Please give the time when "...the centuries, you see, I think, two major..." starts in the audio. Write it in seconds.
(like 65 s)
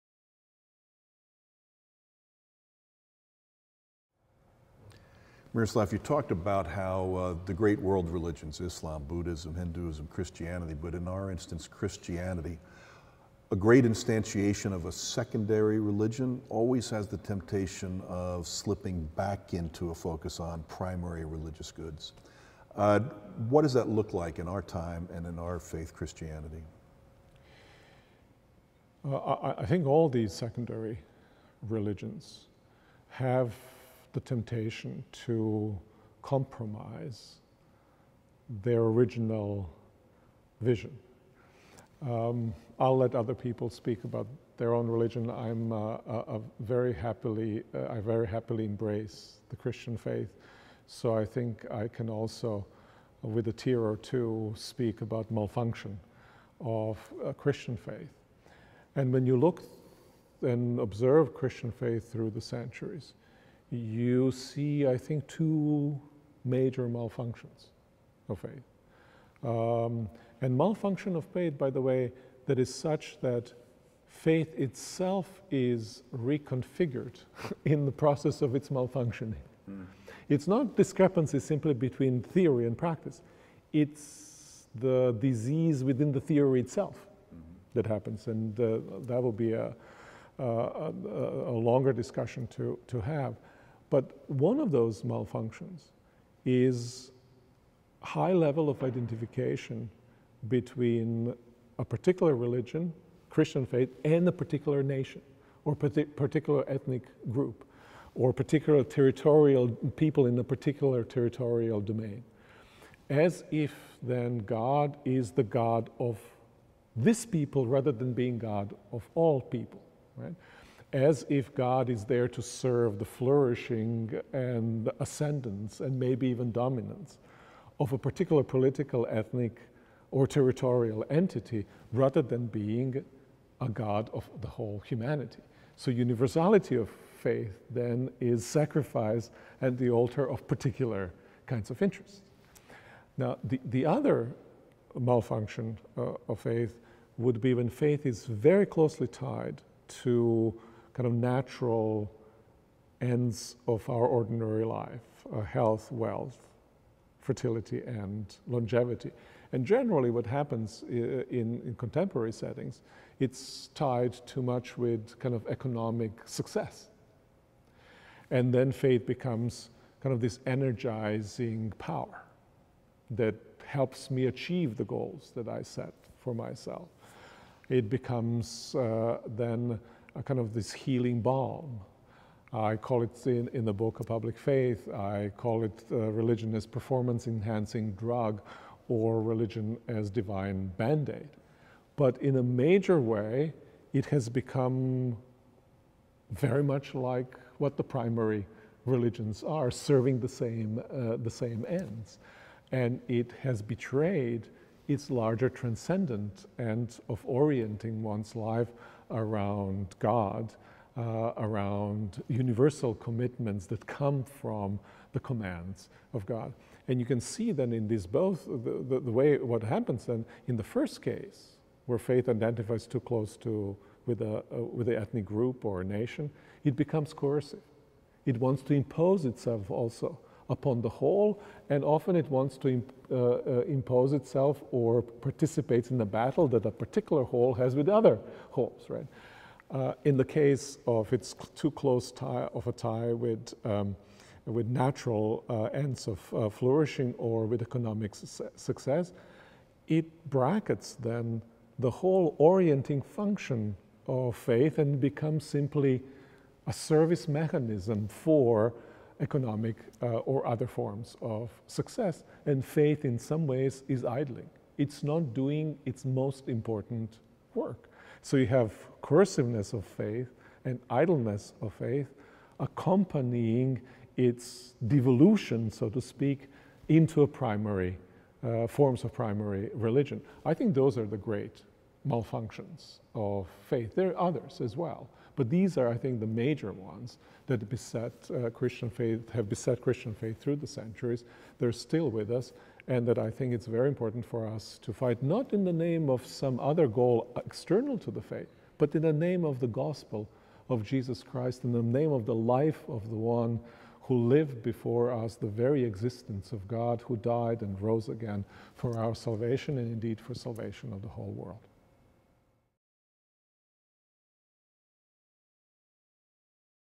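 62 s.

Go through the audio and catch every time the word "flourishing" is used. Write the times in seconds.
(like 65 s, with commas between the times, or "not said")
123 s, 246 s.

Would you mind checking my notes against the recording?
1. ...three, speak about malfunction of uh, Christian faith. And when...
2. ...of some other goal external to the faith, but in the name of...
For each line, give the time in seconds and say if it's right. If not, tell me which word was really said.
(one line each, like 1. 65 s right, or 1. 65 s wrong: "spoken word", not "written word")
1. 53 s wrong: "two", not "three"
2. 296 s right.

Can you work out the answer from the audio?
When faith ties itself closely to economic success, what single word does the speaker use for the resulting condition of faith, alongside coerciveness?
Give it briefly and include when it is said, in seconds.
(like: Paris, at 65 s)
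idleness, at 270 s.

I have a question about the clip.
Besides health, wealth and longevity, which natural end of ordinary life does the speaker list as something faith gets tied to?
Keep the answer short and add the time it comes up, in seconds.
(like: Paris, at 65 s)
fertility, at 157 s.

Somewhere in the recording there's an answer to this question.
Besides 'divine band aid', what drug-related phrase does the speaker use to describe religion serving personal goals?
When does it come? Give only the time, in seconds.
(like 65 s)
186 s.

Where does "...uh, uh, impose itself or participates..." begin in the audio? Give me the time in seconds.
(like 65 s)
233 s.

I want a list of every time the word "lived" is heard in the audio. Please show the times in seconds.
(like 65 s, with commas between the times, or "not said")
304 s.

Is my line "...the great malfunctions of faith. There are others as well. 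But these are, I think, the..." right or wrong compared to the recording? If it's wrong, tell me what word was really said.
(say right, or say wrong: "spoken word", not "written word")
right.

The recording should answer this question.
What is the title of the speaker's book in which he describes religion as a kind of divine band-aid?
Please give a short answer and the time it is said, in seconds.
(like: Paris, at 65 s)
A Public Faith, at 184 s.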